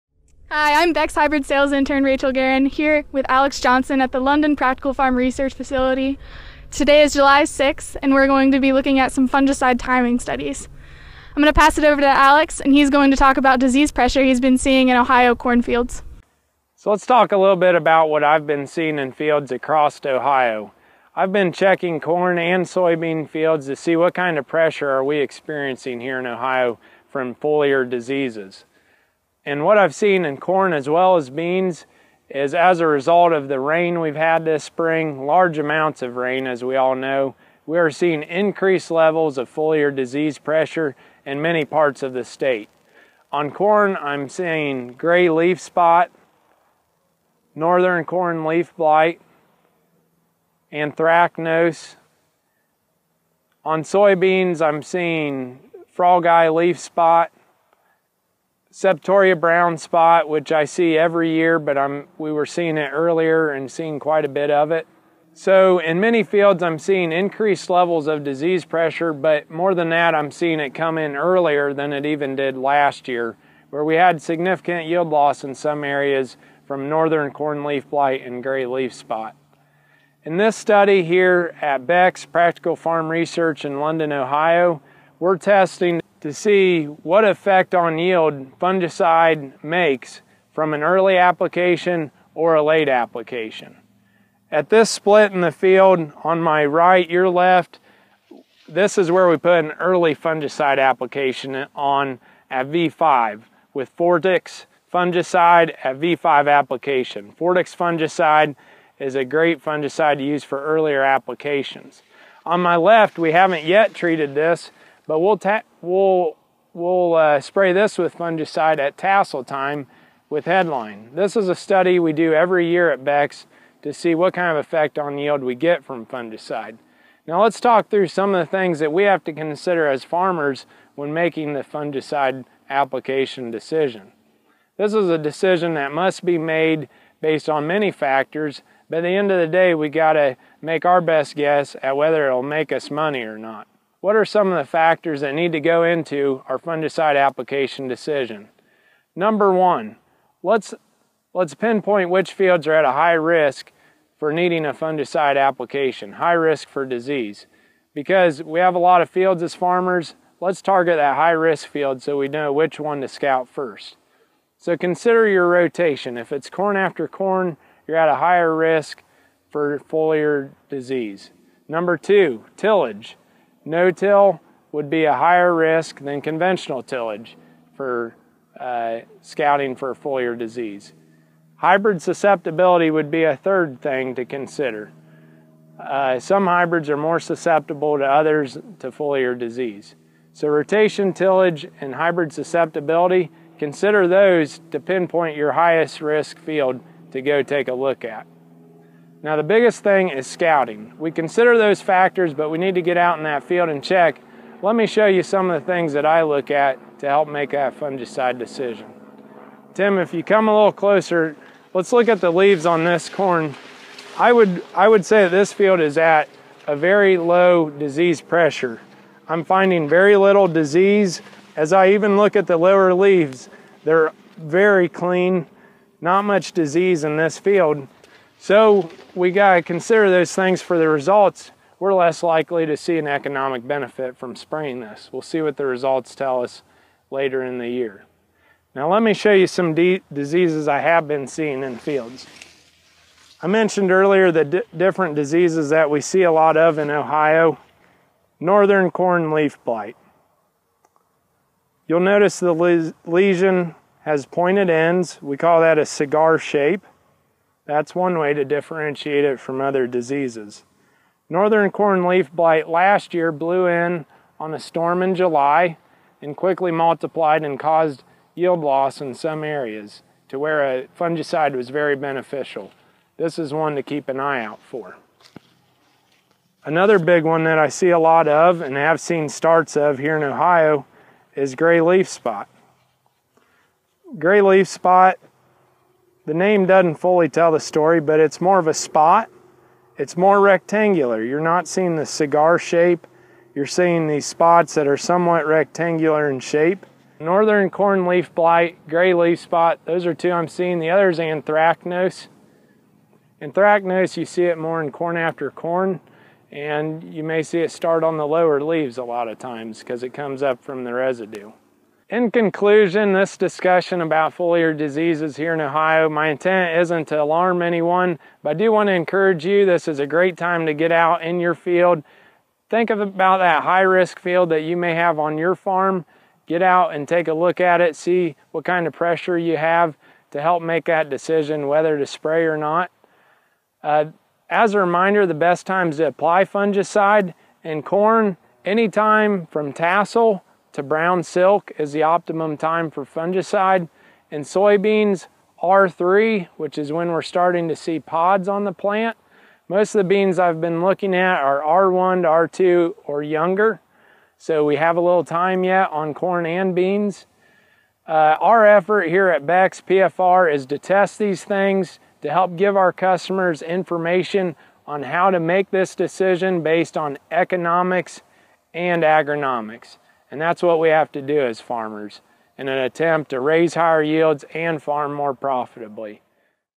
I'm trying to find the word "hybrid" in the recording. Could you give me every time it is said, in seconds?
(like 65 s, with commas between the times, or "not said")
1 s, 181 s, 186 s, 191 s.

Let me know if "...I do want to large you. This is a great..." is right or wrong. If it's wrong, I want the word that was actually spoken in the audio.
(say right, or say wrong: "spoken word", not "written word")
wrong: "encourage", not "large".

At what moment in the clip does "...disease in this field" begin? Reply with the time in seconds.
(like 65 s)
226 s.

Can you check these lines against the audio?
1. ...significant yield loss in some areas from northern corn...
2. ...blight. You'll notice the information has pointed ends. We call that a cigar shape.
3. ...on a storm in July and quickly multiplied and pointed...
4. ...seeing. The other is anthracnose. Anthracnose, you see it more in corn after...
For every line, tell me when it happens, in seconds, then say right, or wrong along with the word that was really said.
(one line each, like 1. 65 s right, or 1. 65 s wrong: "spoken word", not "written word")
1. 74 s right
2. 249 s wrong: "lesion", not "information"
3. 264 s wrong: "caused", not "pointed"
4. 300 s right.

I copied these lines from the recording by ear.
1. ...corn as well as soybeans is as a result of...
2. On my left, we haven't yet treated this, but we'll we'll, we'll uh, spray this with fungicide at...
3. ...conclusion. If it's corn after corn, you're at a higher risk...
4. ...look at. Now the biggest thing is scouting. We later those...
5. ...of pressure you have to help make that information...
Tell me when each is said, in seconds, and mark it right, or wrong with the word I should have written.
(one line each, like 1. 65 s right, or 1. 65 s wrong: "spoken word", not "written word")
1. 30 s wrong: "beans", not "soybeans"
2. 112 s right
3. 165 s wrong: "rotation", not "conclusion"
4. 197 s wrong: "consider", not "later"
5. 328 s wrong: "decision", not "information".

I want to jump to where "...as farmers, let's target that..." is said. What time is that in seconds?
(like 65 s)
159 s.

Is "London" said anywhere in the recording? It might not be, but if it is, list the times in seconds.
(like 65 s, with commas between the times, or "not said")
4 s, 83 s.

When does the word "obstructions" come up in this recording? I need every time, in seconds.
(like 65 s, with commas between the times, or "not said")
not said.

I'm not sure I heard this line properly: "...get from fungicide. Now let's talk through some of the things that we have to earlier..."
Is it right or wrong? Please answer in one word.
wrong.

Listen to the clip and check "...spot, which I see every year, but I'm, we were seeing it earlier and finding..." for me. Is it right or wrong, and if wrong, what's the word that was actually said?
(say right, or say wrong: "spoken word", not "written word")
wrong: "seeing", not "finding".